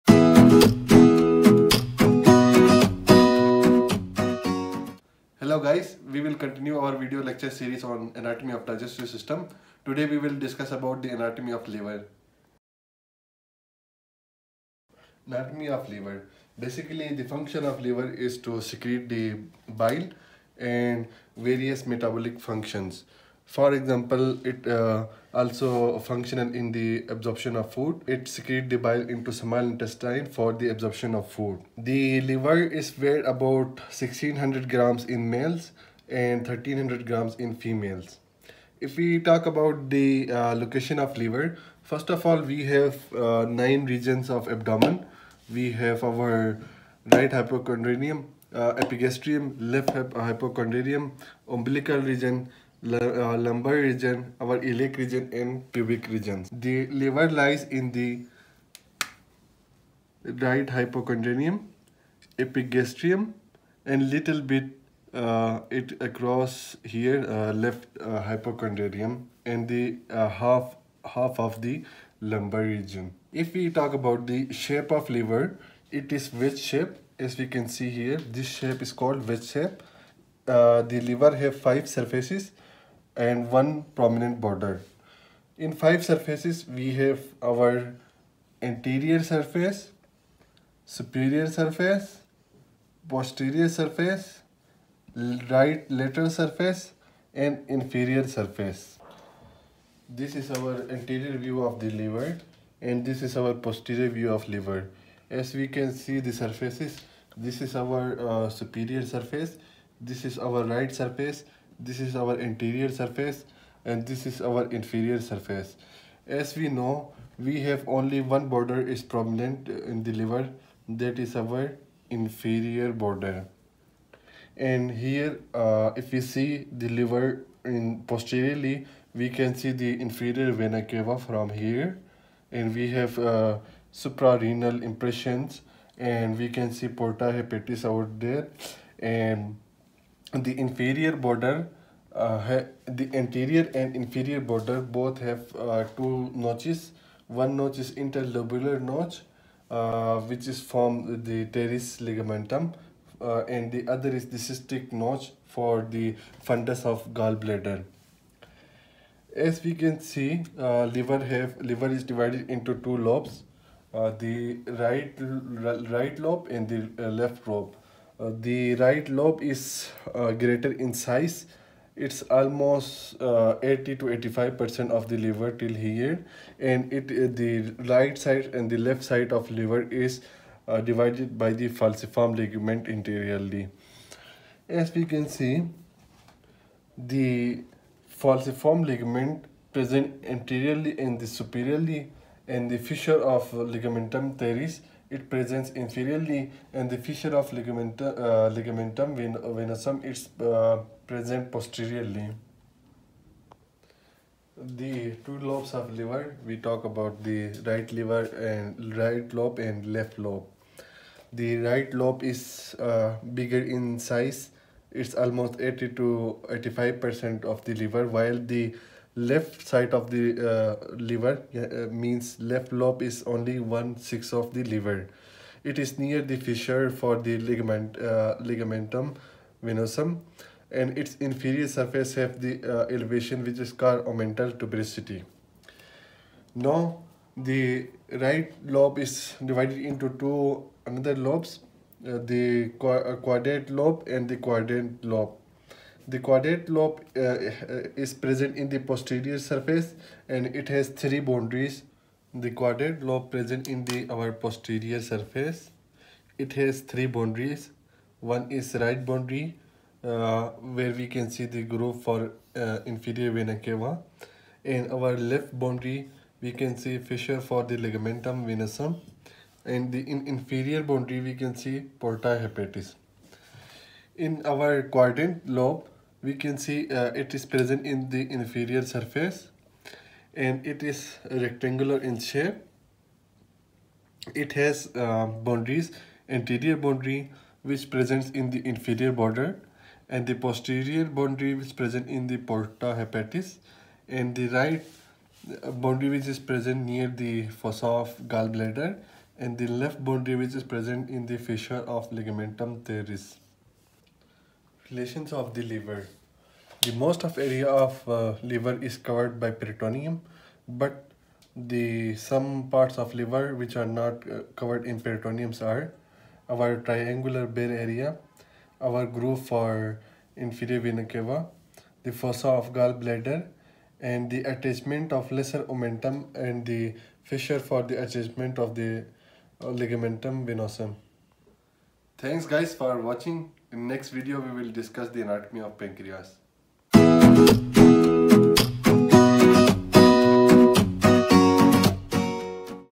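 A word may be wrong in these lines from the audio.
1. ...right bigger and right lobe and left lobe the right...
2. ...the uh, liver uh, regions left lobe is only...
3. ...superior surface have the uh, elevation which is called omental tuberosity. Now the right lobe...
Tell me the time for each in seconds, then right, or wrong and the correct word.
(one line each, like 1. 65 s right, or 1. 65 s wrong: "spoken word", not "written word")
1. 207 s wrong: "liver", not "bigger"
2. 220 s wrong: "means", not "regions"
3. 231 s wrong: "inferior", not "superior".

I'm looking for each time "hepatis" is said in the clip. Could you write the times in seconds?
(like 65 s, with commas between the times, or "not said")
137 s, 272 s, 293 s.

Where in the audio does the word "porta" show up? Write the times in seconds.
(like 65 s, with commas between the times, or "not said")
136 s, 271 s, 292 s.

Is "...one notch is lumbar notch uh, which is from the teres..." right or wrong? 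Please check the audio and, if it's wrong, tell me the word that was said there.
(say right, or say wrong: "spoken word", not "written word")
wrong: "interlobular", not "lumbar".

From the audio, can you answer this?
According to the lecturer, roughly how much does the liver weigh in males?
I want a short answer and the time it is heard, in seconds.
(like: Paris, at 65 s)
1600 grams, at 33 s.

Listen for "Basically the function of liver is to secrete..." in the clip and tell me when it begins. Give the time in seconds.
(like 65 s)
16 s.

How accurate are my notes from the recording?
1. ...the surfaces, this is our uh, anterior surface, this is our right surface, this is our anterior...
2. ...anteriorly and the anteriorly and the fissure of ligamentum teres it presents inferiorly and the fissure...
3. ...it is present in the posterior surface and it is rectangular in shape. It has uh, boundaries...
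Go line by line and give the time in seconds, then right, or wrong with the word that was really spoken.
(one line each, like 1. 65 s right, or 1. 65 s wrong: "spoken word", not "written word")
1. 106 s wrong: "superior", not "anterior"
2. 190 s wrong: "superiorly", not "anteriorly"
3. 277 s wrong: "inferior", not "posterior".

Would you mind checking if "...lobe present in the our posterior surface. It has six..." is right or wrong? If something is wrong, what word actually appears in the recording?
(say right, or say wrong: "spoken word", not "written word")
wrong: "three", not "six".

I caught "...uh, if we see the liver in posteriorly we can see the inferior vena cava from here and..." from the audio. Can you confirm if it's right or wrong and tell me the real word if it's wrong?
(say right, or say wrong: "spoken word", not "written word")
right.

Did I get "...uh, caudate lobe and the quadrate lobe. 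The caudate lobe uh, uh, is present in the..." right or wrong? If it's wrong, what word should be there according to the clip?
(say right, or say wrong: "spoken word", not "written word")
right.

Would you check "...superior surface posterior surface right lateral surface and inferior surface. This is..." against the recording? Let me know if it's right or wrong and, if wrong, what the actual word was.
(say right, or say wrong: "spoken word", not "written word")
right.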